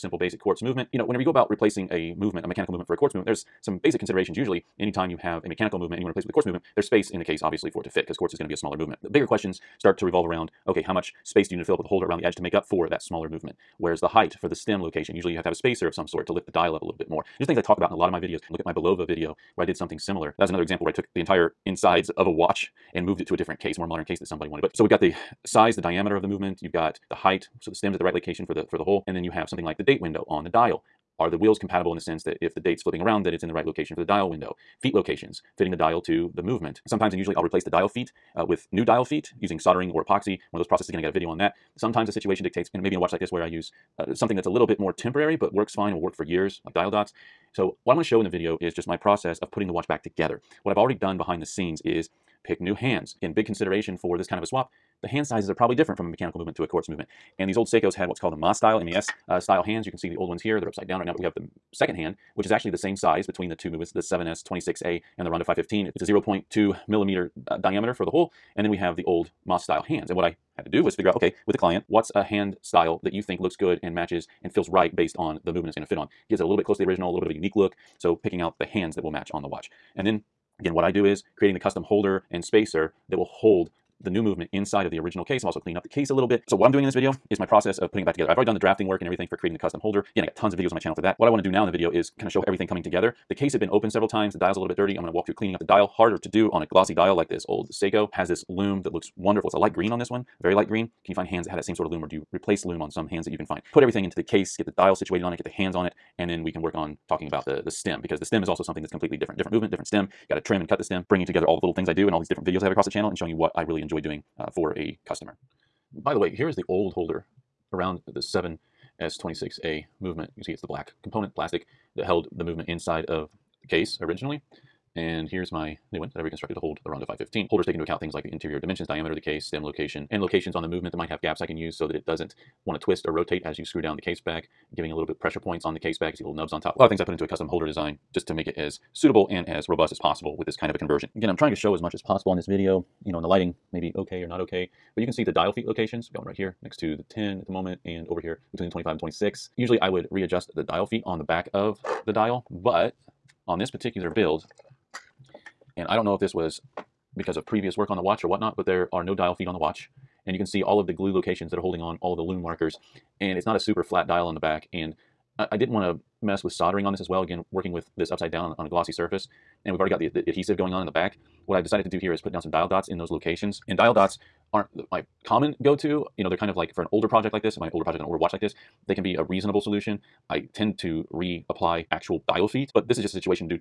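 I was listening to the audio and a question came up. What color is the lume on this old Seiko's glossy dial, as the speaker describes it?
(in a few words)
Very light green.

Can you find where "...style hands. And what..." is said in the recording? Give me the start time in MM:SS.
01:09.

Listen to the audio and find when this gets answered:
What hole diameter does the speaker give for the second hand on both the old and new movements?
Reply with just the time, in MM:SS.
01:06.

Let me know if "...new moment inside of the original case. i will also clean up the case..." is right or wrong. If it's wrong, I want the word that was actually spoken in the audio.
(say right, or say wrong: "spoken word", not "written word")
wrong: "movement", not "moment".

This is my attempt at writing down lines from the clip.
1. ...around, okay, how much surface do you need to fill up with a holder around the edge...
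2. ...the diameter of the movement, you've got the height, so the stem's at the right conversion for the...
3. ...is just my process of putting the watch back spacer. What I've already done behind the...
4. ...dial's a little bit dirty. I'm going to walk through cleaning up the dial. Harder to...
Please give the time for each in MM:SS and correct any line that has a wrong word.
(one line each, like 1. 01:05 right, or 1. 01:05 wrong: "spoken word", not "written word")
1. 00:10 wrong: "space", not "surface"
2. 00:25 wrong: "location", not "conversion"
3. 00:48 wrong: "together", not "spacer"
4. 01:34 right.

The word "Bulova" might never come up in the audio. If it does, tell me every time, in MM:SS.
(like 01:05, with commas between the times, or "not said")
00:18.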